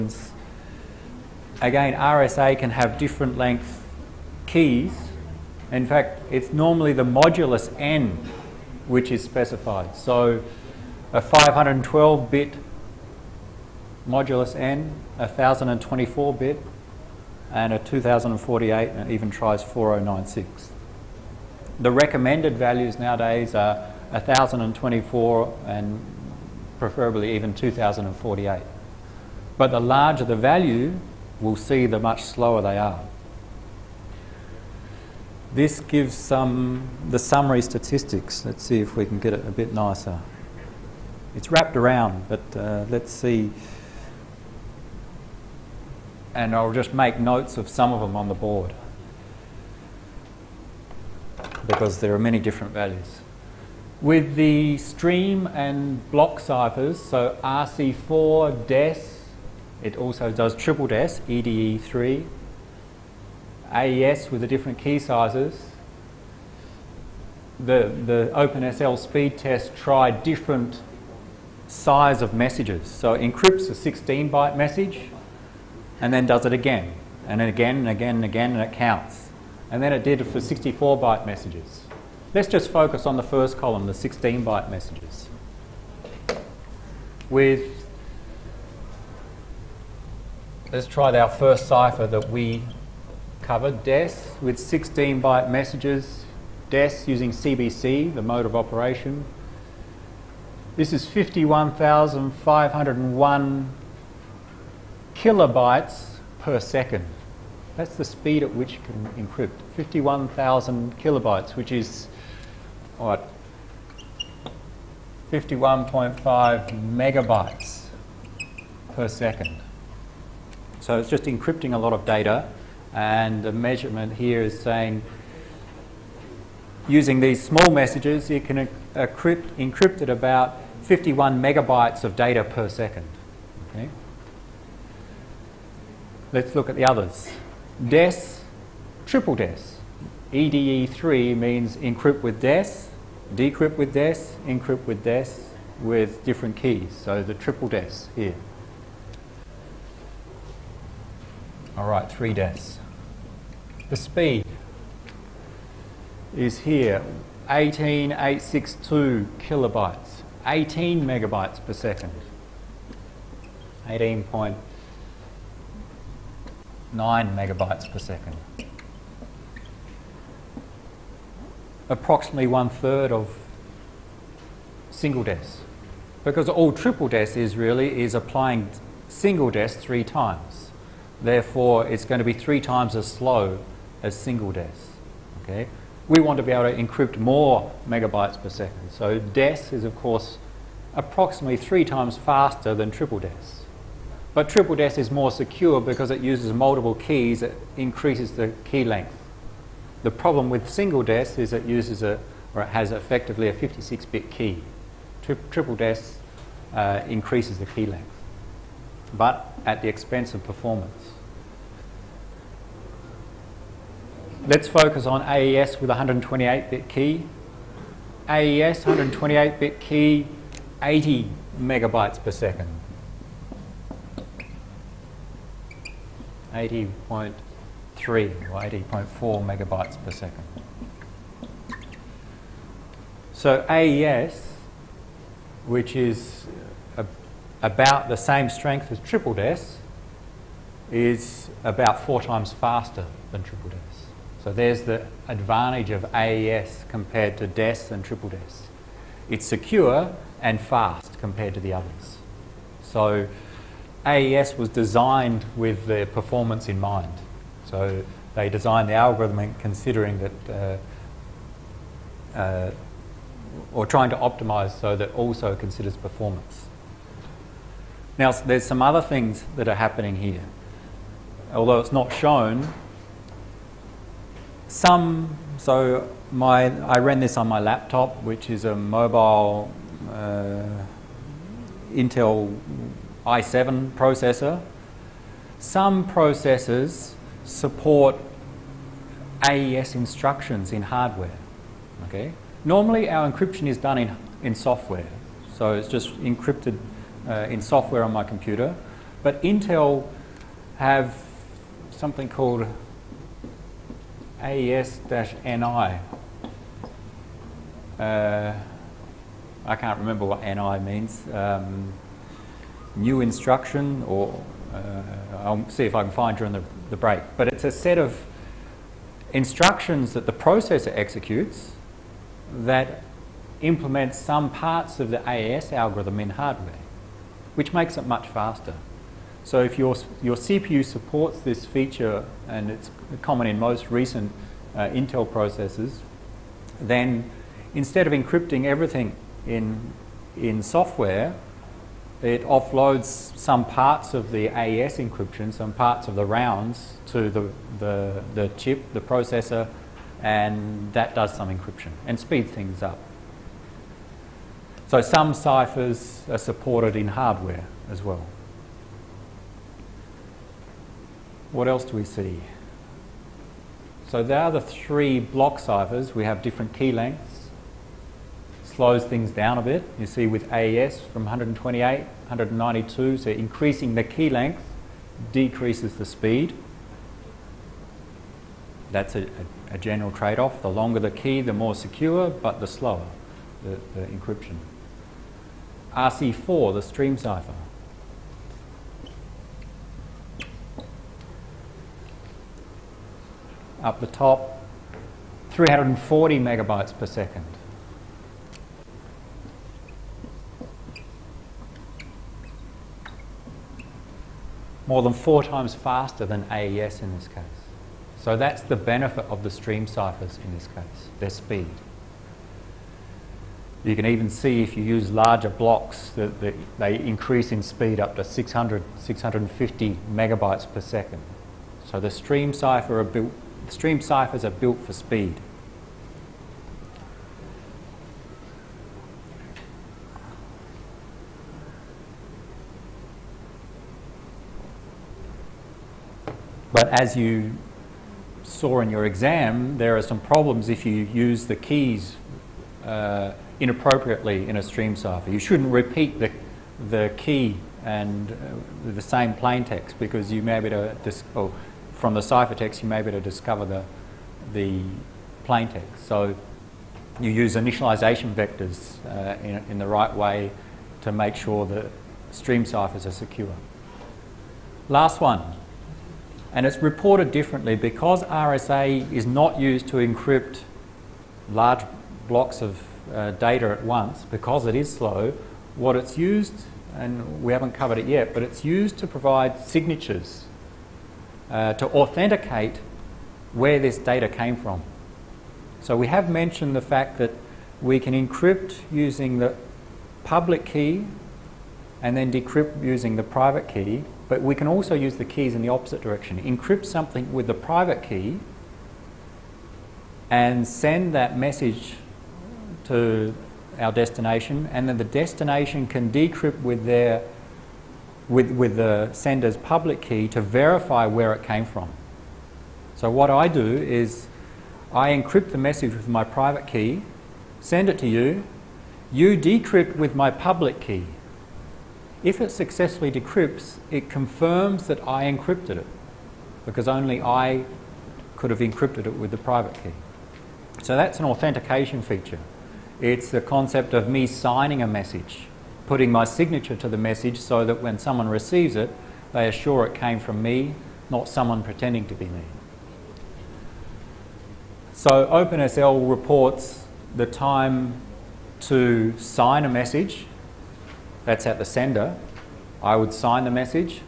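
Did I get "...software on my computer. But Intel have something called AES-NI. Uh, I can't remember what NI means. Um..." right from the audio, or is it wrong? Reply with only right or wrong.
right.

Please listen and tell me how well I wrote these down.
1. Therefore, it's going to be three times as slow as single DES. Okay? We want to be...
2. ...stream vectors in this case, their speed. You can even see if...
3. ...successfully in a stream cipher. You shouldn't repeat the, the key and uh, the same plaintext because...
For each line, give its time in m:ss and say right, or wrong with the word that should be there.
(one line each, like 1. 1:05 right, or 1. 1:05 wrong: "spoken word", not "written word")
1. 3:01 right
2. 6:49 wrong: "ciphers", not "vectors"
3. 7:23 wrong: "inappropriately", not "successfully".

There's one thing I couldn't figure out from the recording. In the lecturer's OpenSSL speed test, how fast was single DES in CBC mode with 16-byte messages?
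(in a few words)
51,501 kilobytes per second.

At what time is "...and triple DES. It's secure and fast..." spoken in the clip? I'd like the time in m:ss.
4:07.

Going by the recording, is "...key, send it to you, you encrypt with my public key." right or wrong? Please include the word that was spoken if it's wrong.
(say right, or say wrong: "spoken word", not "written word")
wrong: "decrypt", not "encrypt".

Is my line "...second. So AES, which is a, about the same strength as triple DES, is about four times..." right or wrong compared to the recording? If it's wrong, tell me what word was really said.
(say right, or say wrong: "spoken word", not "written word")
right.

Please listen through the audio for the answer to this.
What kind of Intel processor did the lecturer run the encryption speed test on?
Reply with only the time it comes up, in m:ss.
4:38.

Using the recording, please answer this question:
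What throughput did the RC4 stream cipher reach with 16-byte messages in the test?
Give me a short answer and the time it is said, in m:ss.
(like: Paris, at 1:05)
340 megabytes per second, at 6:35.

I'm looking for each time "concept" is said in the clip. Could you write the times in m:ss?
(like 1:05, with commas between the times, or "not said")
8:53.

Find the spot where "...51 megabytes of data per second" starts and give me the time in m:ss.
2:10.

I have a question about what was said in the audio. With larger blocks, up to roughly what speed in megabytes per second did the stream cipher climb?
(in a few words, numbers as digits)
650 megabytes per second.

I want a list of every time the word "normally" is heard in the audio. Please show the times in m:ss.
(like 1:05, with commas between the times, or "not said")
0:06, 4:52.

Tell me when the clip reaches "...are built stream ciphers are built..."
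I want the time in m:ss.
7:02.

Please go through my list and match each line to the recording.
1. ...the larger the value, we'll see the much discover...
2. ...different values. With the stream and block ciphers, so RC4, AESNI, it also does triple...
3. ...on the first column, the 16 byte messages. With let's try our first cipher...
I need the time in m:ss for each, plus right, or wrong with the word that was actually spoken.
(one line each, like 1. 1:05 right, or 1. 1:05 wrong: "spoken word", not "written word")
1. 0:29 wrong: "slower", not "discover"
2. 0:52 wrong: "DES", not "AESNI"
3. 1:23 right.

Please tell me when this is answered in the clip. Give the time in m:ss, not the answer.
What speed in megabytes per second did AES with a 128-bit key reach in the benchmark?
3:40.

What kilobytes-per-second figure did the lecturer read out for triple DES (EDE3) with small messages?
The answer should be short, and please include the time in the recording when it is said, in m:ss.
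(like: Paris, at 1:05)
18862 kilobytes, at 2:37.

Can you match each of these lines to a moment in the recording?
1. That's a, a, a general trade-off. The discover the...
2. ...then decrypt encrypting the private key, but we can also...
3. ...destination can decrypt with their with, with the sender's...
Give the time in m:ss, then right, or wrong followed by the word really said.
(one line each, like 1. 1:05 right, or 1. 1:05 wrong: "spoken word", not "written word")
1. 6:18 wrong: "longer", not "discover"
2. 8:12 wrong: "using", not "encrypting"
3. 8:25 right.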